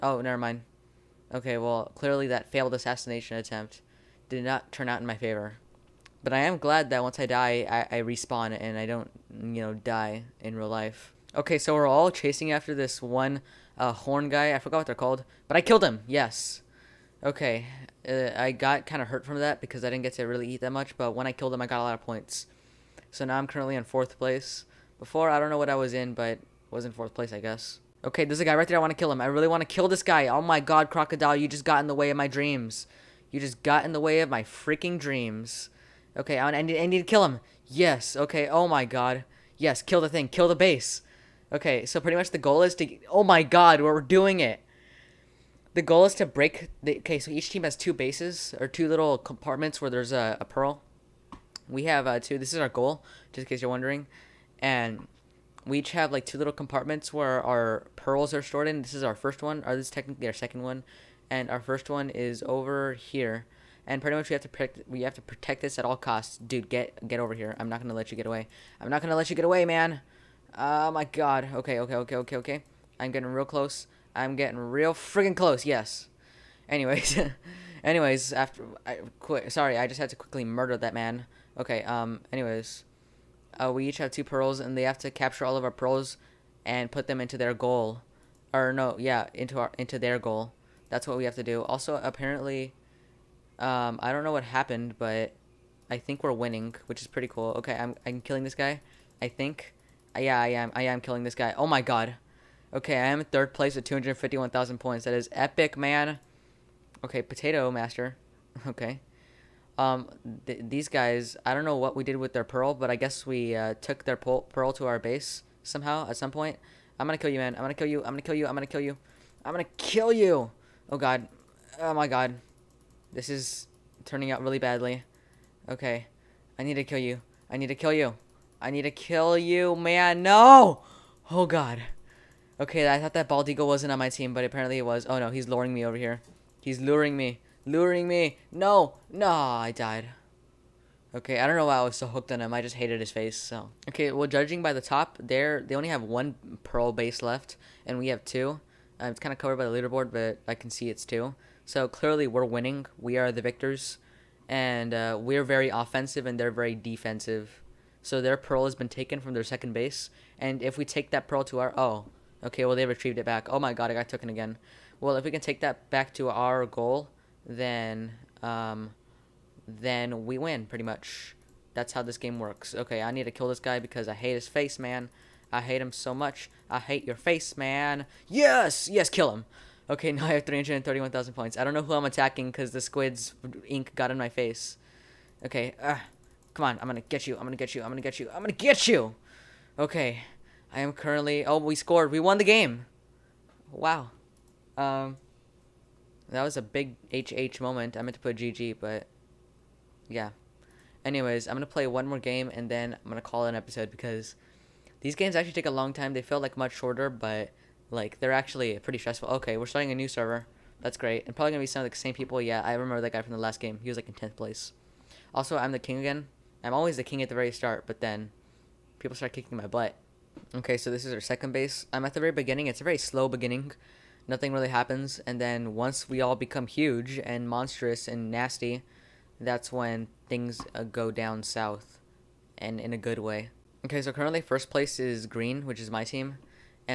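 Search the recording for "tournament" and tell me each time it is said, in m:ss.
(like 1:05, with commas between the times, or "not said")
not said.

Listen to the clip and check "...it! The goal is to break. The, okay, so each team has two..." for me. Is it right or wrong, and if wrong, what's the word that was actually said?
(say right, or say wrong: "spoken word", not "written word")
right.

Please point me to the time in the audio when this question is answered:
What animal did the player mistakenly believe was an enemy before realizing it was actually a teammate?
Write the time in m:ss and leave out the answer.
2:13.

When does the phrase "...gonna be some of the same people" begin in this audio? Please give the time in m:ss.
3:31.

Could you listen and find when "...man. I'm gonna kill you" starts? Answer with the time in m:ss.
1:57.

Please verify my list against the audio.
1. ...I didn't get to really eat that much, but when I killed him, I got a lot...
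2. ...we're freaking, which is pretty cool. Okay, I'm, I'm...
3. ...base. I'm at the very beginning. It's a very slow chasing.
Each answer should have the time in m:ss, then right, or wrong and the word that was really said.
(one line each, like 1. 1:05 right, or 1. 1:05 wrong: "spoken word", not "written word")
1. 0:19 right
2. 1:36 wrong: "winning", not "freaking"
3. 3:41 wrong: "beginning", not "chasing".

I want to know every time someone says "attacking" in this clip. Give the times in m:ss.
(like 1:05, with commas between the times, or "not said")
3:02.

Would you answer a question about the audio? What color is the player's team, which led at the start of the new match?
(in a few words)
green.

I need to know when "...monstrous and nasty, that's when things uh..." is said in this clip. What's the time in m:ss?
3:47.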